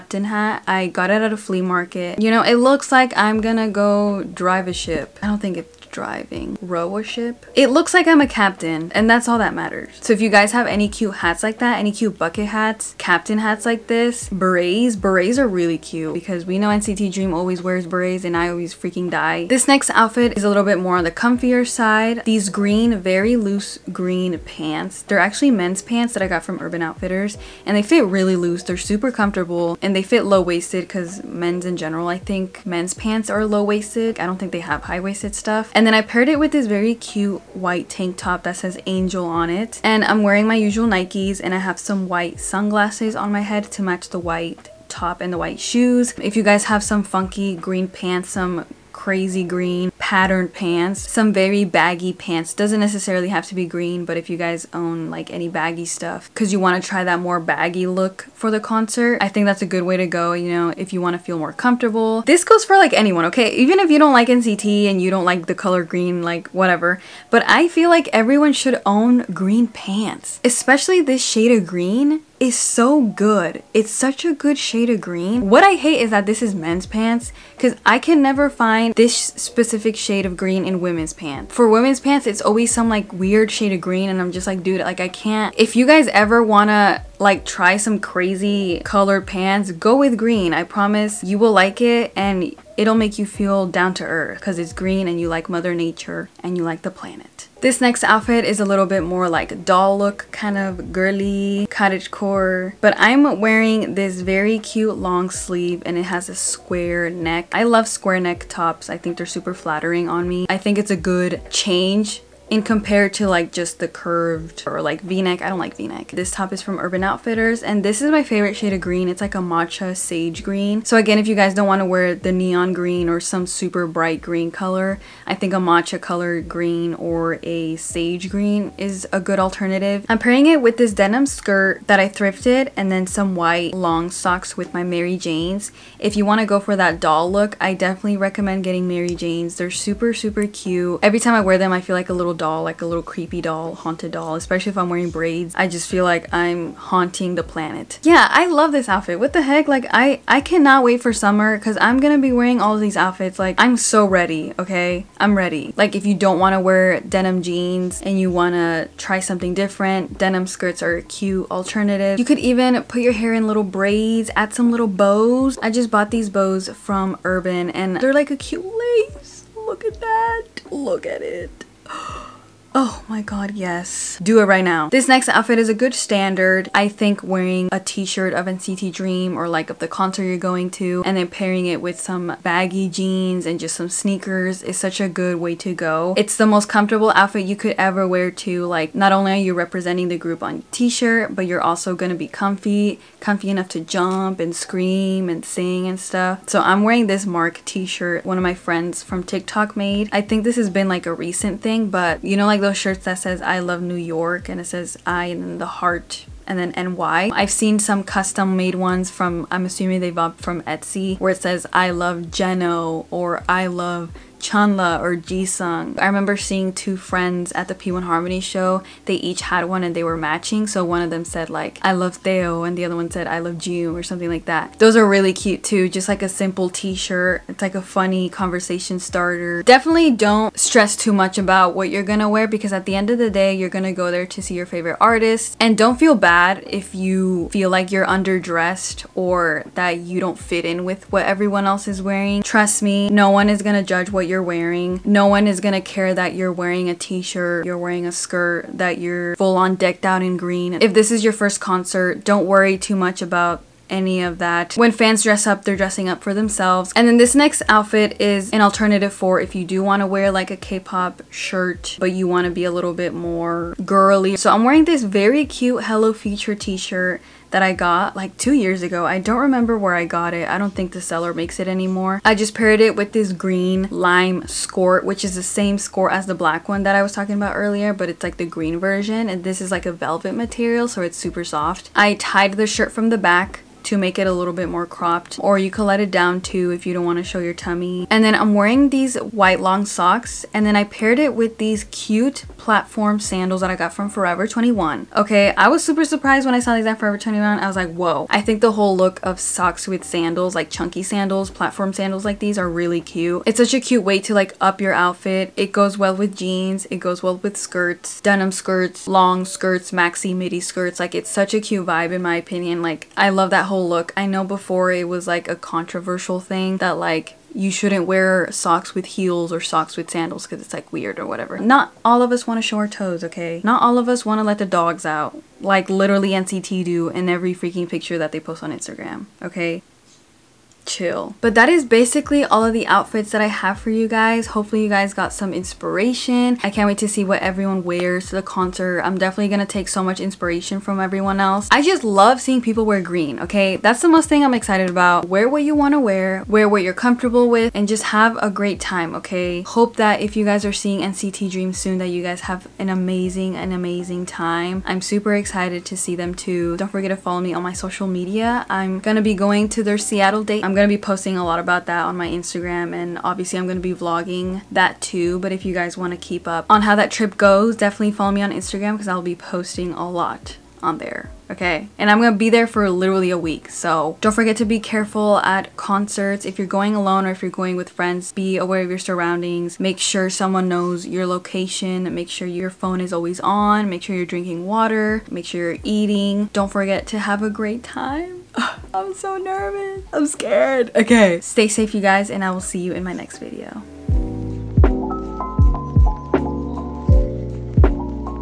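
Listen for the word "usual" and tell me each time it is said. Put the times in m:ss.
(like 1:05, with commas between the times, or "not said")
0:40.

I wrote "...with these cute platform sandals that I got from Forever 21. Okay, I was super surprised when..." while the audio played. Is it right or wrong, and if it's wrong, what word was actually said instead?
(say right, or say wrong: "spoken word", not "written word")
right.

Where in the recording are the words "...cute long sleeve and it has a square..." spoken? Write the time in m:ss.
1:44.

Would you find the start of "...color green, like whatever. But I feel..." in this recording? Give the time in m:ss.
1:05.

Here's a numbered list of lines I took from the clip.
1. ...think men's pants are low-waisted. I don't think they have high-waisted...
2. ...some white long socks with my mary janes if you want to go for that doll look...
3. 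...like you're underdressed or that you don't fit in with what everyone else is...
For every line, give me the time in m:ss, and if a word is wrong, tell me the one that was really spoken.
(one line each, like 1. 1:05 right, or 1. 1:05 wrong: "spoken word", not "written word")
1. 0:32 right
2. 2:13 right
3. 3:57 right.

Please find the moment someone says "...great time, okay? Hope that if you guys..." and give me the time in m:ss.
5:48.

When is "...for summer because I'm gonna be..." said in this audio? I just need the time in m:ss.
2:31.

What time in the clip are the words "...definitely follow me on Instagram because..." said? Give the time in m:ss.
6:07.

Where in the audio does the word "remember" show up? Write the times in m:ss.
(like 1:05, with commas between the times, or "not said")
3:36, 4:29.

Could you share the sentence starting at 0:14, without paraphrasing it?
Berets are really cute because we know NCT Dream always wears berets and I always freaking die.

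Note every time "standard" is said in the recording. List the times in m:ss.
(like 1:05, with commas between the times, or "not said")
2:55.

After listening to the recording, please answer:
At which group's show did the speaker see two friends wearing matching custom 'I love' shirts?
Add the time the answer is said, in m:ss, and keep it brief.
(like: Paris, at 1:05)
P1Harmony, at 3:37.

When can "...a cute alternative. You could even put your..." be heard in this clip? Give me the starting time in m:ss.
2:40.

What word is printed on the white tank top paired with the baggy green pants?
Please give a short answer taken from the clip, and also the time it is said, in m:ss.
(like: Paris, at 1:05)
Angel, at 0:38.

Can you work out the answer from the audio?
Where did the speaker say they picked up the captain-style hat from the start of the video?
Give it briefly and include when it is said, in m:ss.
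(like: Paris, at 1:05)
A flea market, at 0:01.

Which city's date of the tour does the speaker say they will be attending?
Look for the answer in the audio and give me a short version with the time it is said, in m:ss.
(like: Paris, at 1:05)
Seattle, at 5:59.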